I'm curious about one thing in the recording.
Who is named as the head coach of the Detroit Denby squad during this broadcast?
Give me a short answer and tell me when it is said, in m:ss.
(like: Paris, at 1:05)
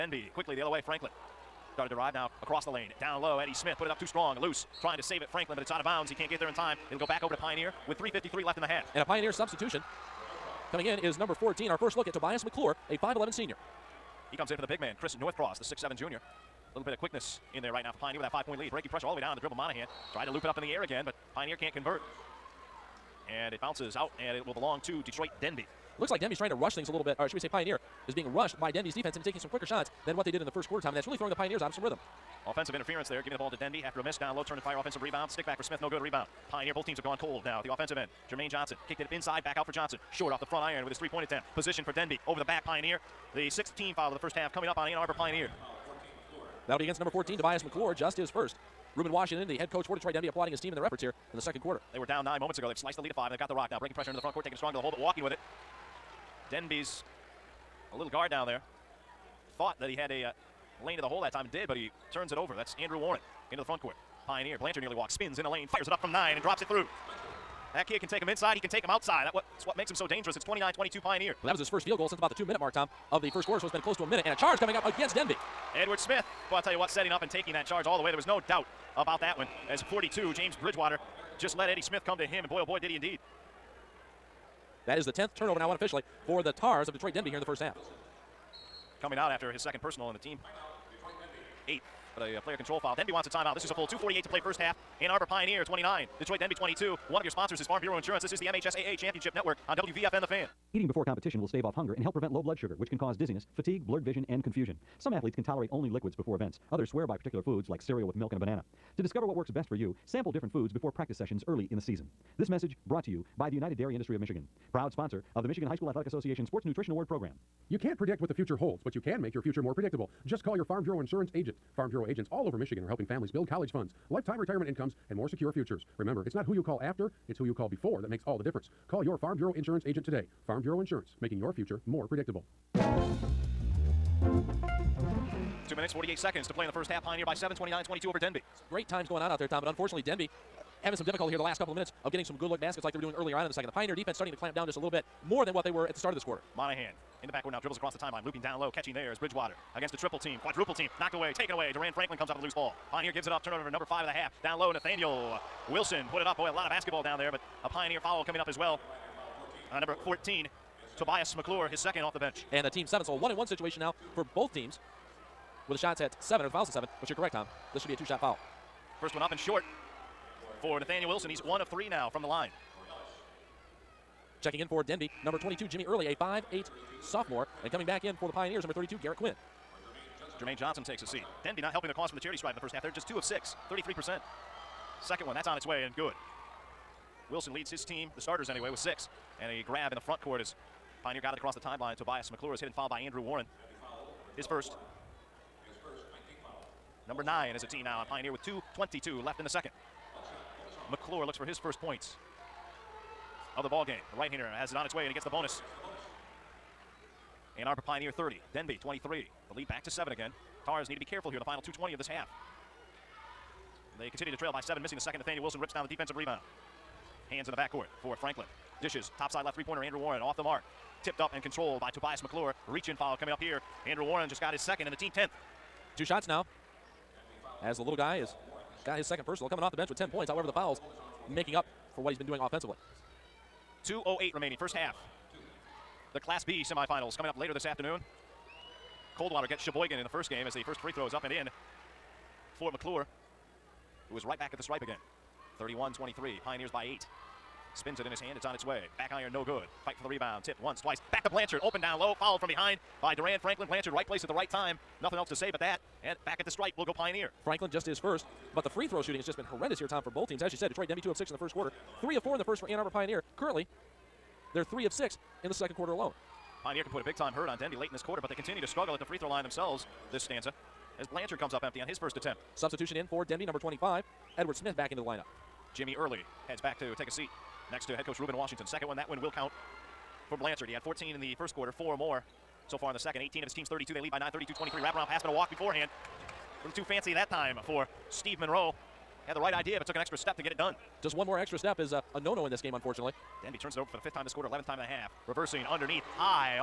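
Reuben Washington, at 0:48.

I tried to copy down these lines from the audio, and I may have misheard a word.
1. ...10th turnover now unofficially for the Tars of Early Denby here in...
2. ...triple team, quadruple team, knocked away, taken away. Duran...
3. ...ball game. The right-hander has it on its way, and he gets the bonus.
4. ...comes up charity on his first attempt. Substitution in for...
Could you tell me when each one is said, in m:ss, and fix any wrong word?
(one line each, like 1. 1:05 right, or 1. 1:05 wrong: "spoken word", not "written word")
1. 1:25 wrong: "Detroit", not "Early"
2. 2:29 right
3. 3:23 right
4. 4:31 wrong: "empty", not "charity".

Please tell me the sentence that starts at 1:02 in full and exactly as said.
That's Andrew Warren into the front court.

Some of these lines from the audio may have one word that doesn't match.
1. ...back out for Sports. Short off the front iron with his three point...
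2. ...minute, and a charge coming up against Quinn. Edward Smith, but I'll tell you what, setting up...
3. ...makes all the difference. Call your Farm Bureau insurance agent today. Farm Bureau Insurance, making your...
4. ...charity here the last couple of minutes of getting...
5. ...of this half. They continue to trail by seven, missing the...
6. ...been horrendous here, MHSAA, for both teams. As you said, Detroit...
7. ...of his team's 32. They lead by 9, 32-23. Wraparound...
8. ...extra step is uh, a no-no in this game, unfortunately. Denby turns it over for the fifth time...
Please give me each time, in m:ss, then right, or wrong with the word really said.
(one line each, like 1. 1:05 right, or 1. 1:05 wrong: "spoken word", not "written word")
1. 0:39 wrong: "Johnson", not "Sports"
2. 1:14 wrong: "Denby", not "Quinn"
3. 2:08 right
4. 2:21 wrong: "difficulty", not "charity"
5. 3:31 right
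6. 4:19 wrong: "Tom", not "MHSAA"
7. 4:43 right
8. 4:51 right.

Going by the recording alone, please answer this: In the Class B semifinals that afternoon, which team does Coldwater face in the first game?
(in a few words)
Cheboygan.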